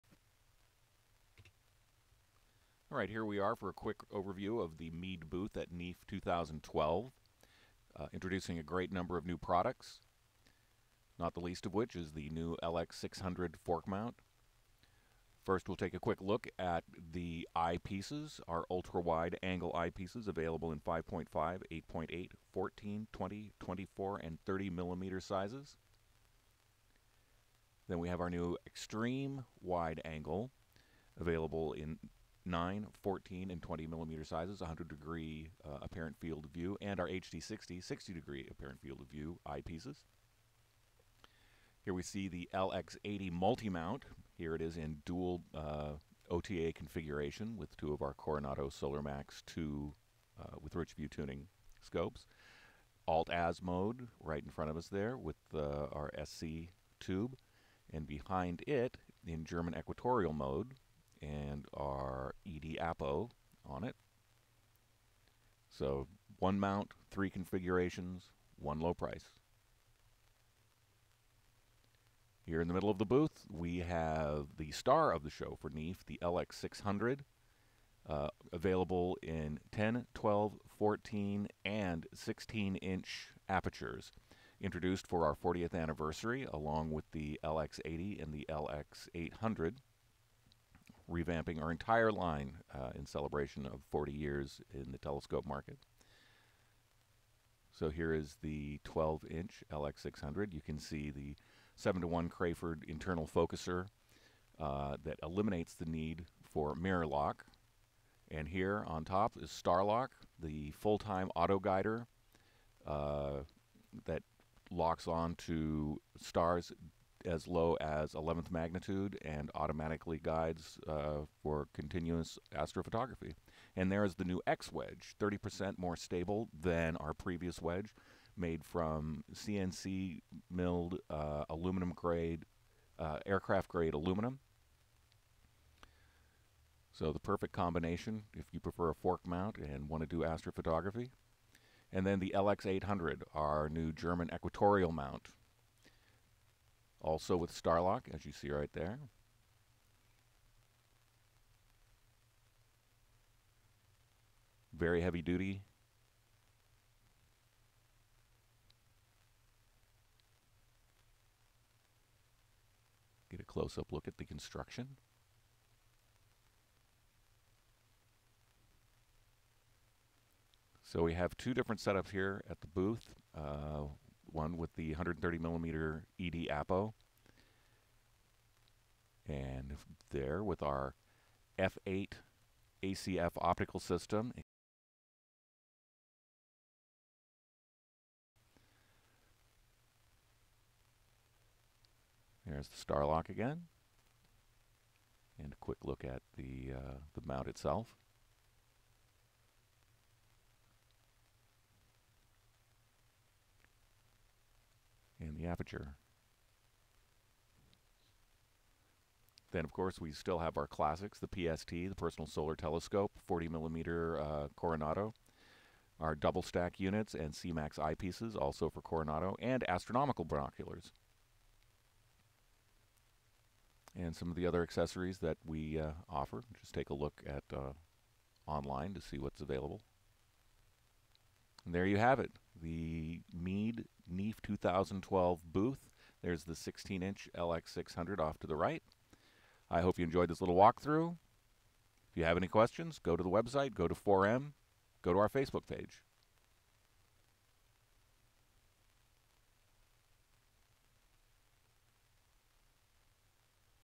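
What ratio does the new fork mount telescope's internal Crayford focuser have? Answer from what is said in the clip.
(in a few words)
7 to 1.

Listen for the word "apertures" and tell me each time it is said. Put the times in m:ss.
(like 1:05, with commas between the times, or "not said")
1:23, 3:25.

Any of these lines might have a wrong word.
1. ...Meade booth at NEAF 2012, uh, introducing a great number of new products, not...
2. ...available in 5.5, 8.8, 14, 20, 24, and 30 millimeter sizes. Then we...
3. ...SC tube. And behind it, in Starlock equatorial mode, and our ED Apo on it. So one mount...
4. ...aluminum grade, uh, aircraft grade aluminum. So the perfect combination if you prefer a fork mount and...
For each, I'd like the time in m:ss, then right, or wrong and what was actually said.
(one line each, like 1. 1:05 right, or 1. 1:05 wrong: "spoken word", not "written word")
1. 0:04 right
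2. 0:20 right
3. 0:56 wrong: "German", not "Starlock"
4. 2:11 right.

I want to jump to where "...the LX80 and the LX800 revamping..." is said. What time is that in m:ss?
1:27.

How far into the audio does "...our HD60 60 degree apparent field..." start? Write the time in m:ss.
0:36.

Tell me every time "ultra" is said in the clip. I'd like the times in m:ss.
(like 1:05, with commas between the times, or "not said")
0:18.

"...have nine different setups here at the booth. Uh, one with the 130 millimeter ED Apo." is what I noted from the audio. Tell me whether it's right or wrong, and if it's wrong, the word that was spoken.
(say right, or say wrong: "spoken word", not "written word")
wrong: "two", not "nine".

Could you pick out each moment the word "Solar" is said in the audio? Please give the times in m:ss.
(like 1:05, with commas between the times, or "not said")
0:48, 3:32.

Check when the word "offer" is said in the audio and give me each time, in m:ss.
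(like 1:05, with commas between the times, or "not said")
3:46.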